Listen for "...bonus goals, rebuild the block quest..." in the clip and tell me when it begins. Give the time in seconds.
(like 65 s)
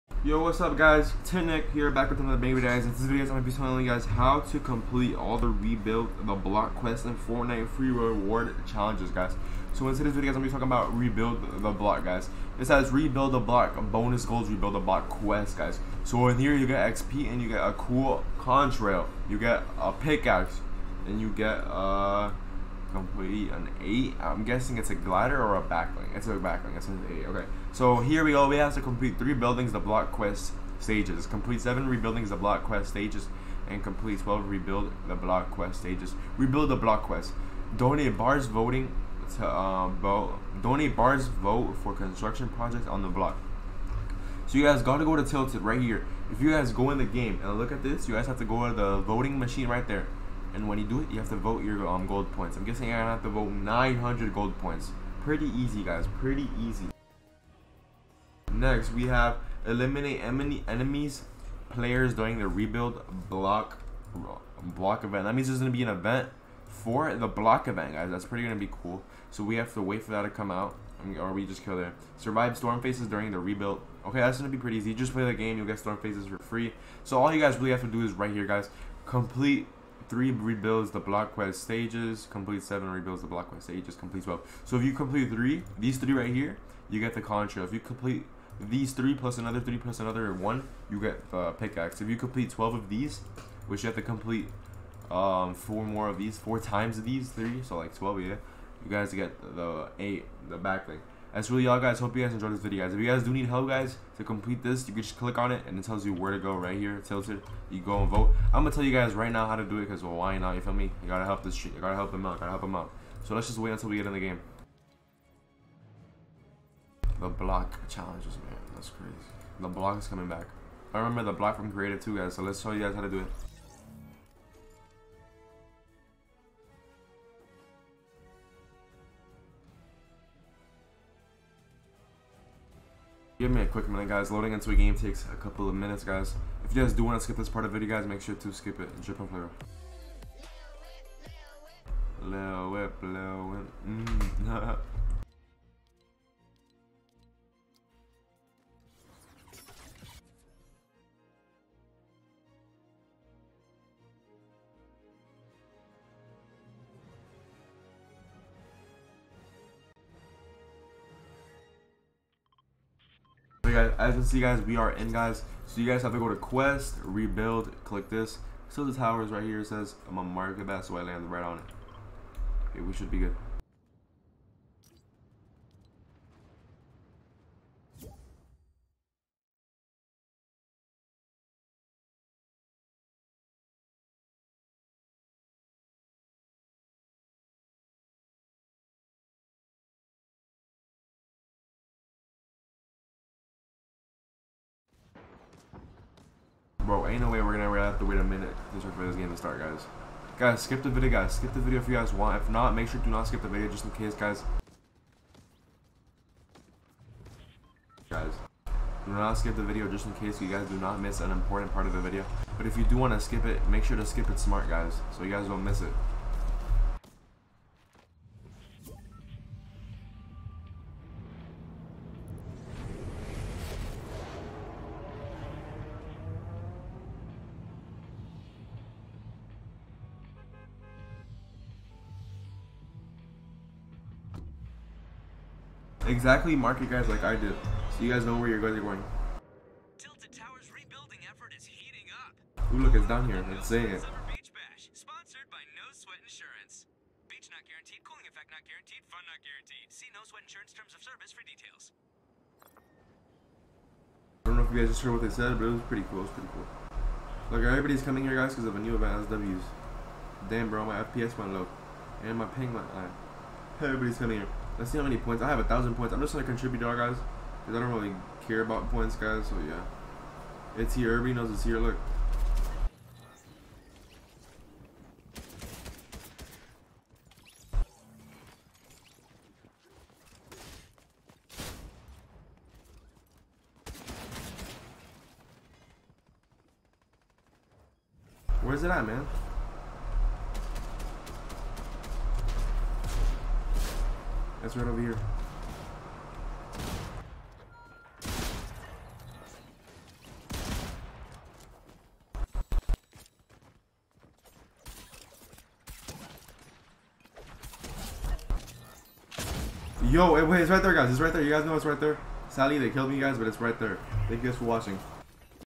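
13 s.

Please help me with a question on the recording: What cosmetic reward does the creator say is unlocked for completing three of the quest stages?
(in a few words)
Contrail.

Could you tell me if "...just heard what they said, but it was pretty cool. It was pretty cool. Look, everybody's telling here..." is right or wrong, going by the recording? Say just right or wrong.
wrong.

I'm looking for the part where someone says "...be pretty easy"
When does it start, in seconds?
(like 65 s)
74 s.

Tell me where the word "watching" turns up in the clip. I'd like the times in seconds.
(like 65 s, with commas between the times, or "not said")
314 s.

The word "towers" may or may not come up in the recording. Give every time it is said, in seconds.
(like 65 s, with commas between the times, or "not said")
168 s, 240 s.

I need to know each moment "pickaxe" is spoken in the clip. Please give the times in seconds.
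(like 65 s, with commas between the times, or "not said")
19 s, 91 s.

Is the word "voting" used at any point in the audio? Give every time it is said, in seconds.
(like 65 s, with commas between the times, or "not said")
38 s, 48 s.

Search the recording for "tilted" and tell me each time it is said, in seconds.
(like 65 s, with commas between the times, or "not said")
45 s, 107 s, 239 s.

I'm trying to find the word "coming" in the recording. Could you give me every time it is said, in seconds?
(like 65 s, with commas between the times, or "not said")
120 s, 258 s, 264 s.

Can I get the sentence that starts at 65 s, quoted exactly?
That means there's gonna be an event for the block event, guys.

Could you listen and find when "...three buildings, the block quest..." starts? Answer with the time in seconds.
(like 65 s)
29 s.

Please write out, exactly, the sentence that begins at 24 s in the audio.
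I'm guessing it's a glider or a back bling.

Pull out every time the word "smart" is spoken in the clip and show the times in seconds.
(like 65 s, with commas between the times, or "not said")
214 s.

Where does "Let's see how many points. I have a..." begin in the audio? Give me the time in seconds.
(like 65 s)
264 s.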